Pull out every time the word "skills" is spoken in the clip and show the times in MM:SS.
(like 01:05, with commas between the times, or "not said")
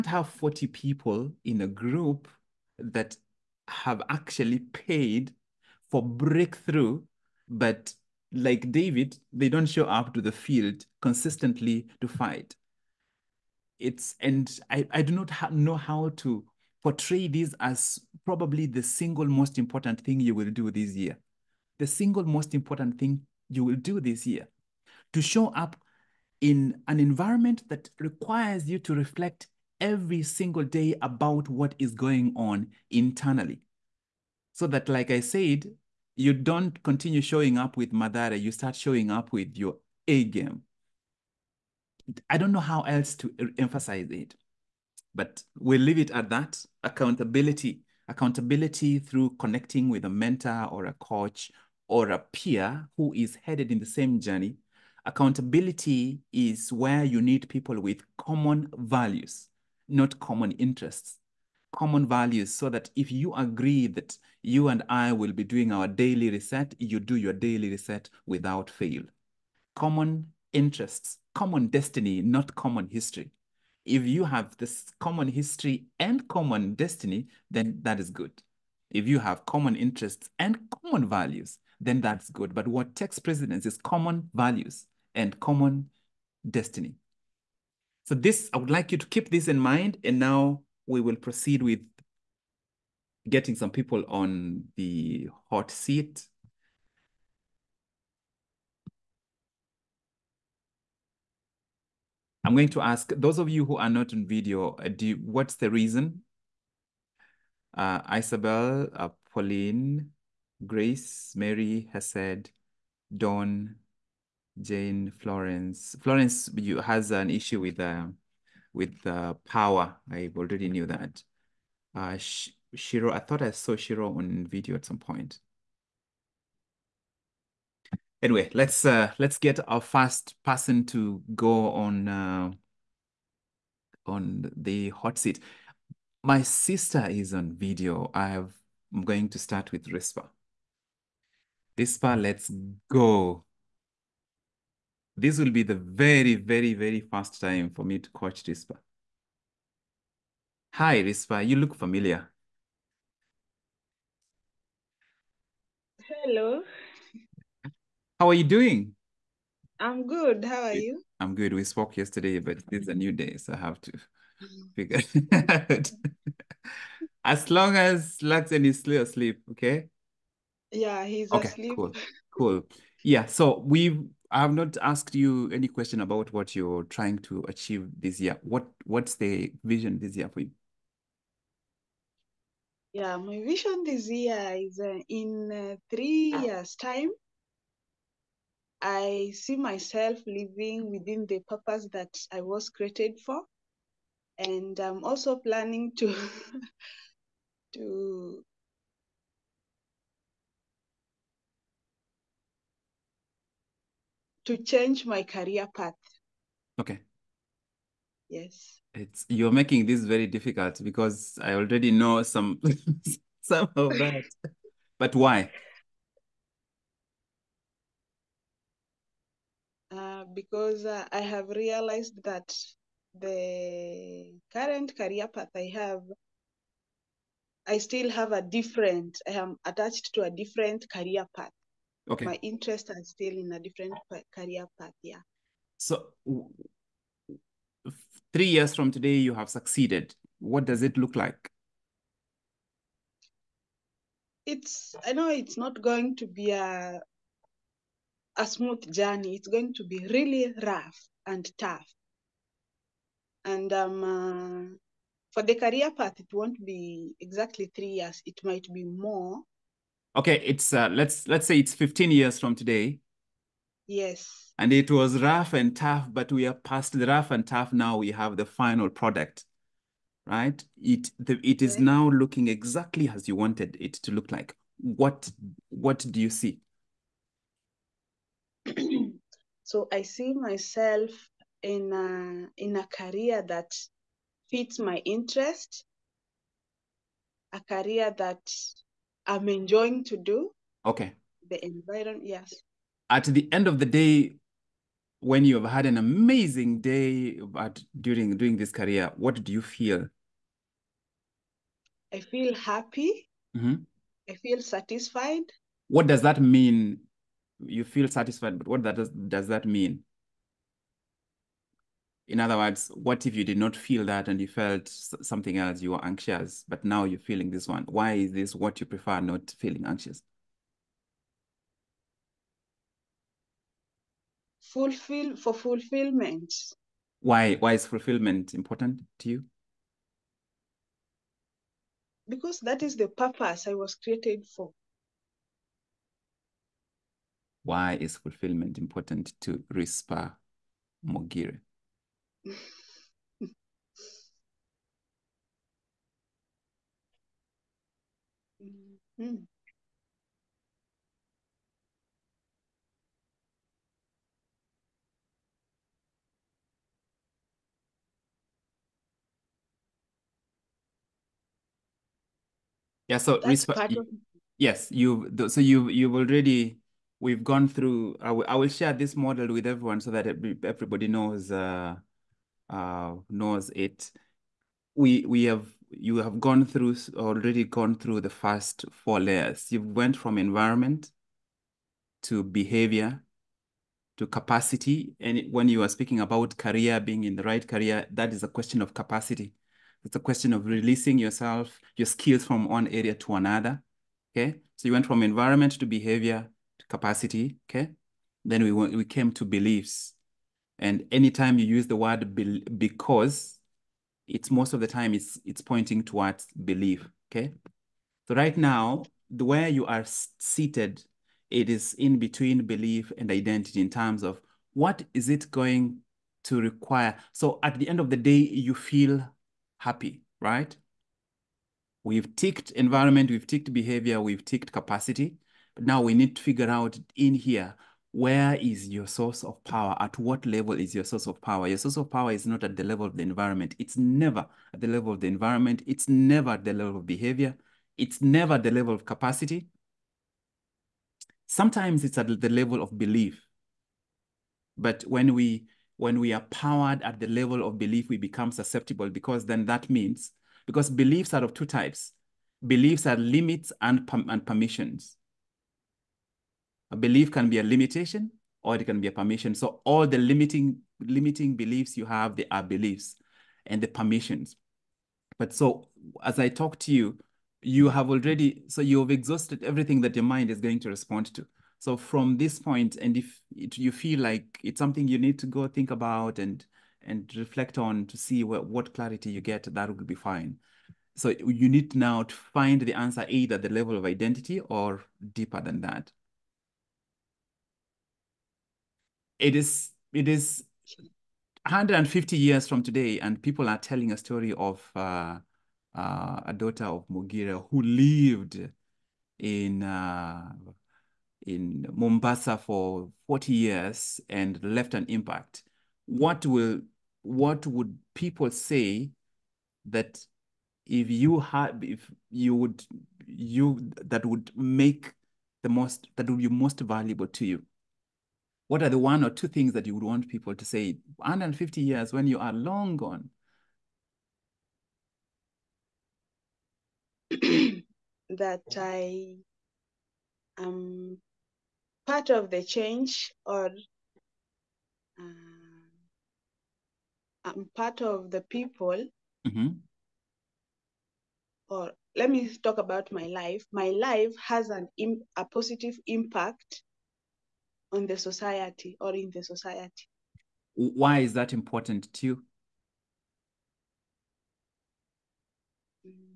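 06:32.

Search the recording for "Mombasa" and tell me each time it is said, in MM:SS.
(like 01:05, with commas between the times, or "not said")
08:21.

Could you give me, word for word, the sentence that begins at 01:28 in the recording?
So this, I would like you to keep this in mind.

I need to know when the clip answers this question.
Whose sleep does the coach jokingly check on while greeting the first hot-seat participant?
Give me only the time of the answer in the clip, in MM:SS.
02:48.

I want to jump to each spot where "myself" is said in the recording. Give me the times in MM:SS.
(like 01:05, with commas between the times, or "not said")
03:09, 04:40.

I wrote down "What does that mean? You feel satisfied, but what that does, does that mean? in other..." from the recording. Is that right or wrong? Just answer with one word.
right.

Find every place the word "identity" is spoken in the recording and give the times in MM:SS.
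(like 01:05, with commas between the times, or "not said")
06:53, 08:04.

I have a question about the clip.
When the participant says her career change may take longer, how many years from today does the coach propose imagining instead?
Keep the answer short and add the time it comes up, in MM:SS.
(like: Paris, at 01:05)
15 years, at 04:21.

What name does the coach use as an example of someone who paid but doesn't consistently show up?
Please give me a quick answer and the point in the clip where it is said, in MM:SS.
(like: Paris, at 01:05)
David, at 00:08.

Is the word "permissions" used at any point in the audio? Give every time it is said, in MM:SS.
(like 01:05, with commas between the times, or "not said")
07:34, 07:39, 07:43.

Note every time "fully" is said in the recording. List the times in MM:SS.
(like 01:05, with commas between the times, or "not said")
not said.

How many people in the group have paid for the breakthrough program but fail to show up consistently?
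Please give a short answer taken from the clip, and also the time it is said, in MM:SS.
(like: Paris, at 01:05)
40, at 00:00.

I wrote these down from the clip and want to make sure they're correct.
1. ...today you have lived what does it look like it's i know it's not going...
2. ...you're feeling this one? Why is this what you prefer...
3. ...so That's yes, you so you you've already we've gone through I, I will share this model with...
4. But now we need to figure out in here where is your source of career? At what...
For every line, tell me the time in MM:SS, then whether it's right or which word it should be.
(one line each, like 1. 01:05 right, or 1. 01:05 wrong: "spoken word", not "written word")
1. 03:58 wrong: "succeeded", not "lived"
2. 05:17 right
3. 06:03 right
4. 07:05 wrong: "power", not "career".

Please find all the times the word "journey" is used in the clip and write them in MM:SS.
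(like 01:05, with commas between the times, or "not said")
00:54, 04:08.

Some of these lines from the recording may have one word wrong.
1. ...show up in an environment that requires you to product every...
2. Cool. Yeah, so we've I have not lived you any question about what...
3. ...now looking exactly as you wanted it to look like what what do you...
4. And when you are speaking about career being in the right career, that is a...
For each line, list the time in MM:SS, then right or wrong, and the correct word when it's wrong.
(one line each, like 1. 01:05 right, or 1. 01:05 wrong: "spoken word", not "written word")
1. 00:25 wrong: "reflect", not "product"
2. 02:52 wrong: "asked", not "lived"
3. 04:31 right
4. 06:25 right.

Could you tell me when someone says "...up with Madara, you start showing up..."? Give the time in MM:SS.
00:37.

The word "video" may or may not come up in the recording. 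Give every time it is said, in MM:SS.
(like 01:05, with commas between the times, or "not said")
01:44, 02:04, 02:17.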